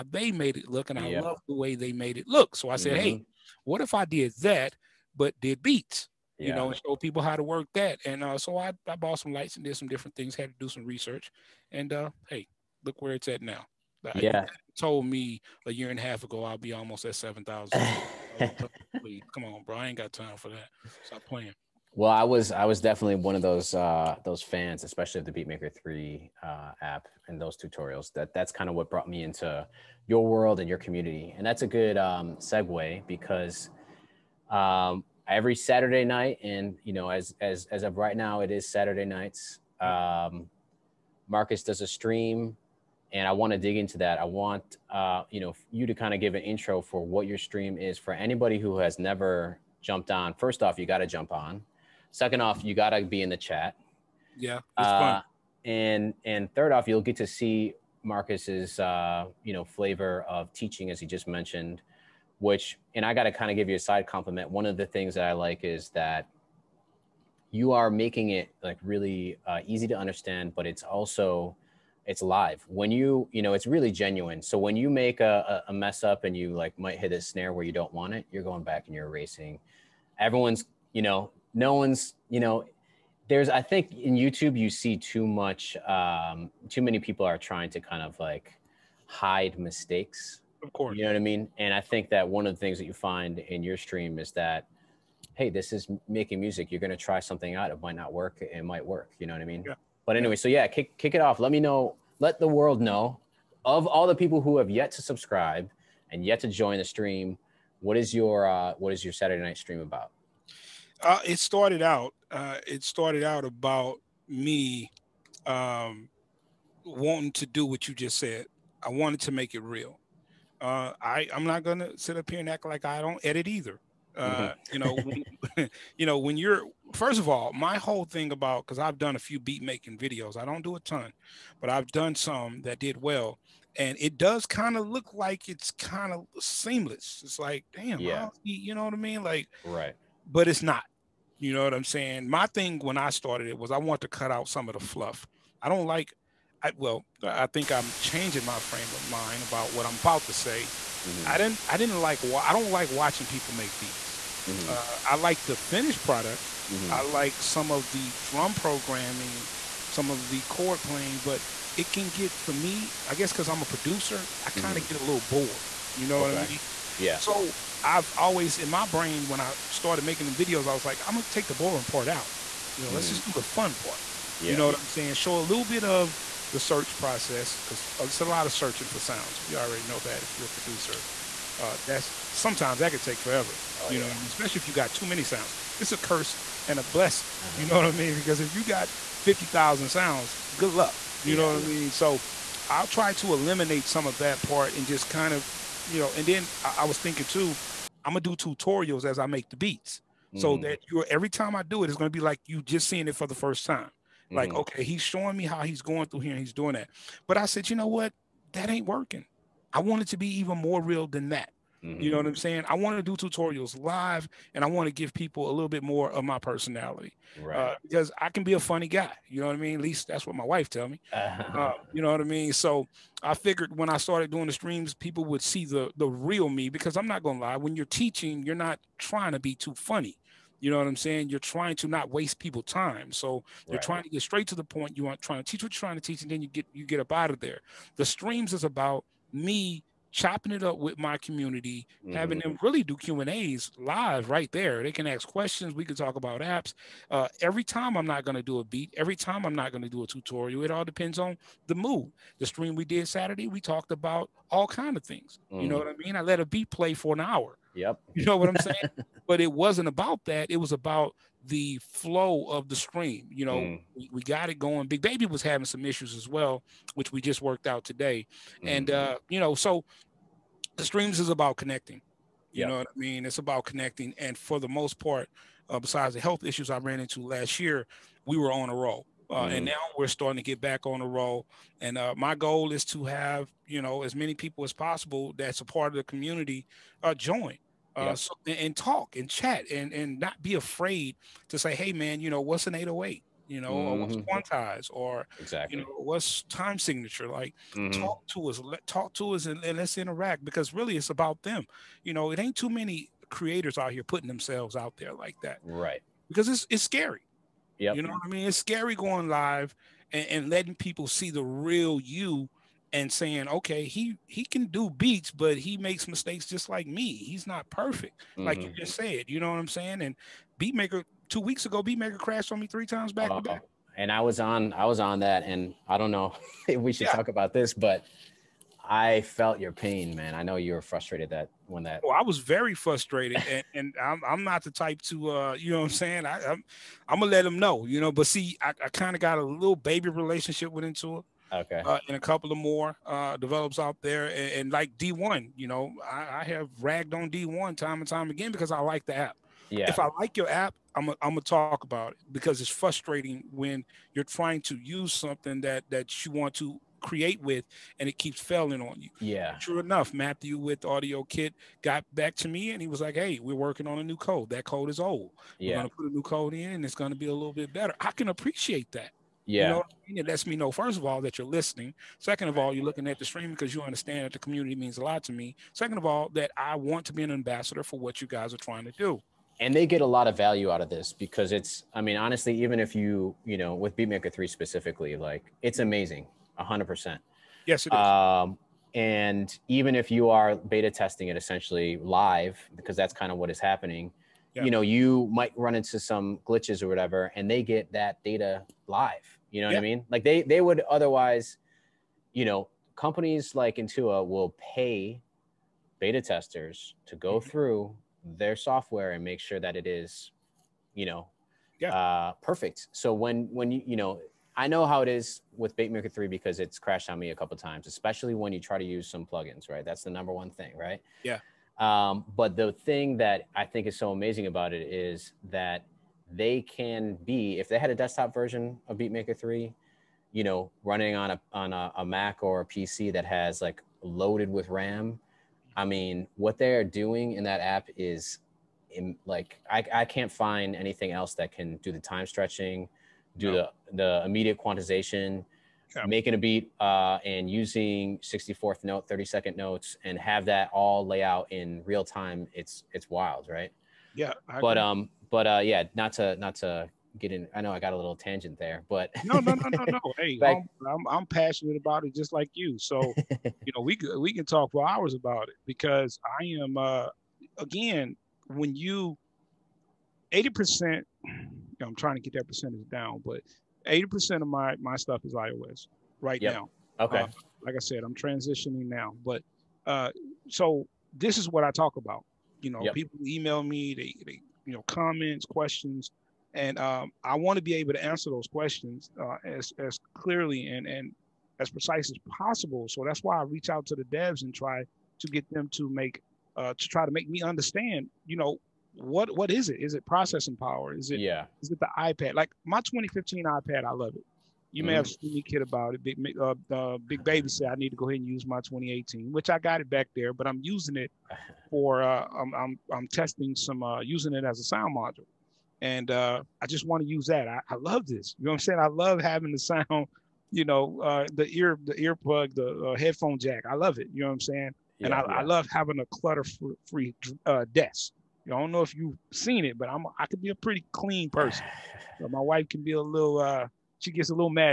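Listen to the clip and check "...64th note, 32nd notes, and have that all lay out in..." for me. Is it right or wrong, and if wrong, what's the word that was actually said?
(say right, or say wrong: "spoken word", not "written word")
right.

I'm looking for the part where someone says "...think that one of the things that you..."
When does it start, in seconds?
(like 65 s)
91 s.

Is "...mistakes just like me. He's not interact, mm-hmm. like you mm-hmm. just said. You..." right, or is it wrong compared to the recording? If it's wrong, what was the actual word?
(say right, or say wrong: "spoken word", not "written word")
wrong: "perfect", not "interact".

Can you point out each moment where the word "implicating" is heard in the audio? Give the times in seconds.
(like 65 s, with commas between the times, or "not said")
not said.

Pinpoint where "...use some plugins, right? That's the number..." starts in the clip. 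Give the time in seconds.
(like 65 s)
418 s.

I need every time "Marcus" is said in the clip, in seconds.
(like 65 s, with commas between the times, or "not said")
41 s, 58 s.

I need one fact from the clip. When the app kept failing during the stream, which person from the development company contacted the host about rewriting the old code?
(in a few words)
Matthew.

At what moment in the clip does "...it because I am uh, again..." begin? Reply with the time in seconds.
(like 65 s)
465 s.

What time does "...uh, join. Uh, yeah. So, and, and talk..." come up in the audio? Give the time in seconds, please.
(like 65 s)
287 s.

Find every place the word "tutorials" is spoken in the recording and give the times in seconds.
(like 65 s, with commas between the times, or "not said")
27 s, 198 s, 213 s, 250 s.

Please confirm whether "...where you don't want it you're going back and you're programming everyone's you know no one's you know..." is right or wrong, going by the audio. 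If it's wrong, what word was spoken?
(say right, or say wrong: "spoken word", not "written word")
wrong: "erasing", not "programming".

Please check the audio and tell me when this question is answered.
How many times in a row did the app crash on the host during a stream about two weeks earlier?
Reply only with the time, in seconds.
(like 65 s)
322 s.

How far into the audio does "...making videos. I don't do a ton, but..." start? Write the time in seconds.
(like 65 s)
129 s.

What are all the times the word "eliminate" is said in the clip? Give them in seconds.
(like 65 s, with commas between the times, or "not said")
193 s.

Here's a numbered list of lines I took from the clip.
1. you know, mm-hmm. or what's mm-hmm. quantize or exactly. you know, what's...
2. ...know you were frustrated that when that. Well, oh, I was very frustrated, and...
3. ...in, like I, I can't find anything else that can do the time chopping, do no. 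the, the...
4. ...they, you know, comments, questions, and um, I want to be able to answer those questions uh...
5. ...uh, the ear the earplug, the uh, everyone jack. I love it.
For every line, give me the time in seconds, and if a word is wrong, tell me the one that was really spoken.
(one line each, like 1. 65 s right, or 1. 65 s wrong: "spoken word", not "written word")
1. 293 s right
2. 330 s right
3. 438 s wrong: "stretching", not "chopping"
4. 484 s right
5. 521 s wrong: "headphone", not "everyone".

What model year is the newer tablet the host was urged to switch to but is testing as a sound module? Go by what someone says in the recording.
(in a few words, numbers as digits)
2018.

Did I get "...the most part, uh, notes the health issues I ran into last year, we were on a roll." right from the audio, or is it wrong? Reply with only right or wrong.
wrong.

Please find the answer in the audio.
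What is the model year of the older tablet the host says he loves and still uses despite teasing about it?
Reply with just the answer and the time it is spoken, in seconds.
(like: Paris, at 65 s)
2015, at 502 s.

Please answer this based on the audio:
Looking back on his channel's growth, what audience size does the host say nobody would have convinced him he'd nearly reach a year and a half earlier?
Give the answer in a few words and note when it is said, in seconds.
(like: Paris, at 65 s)
7,000, at 17 s.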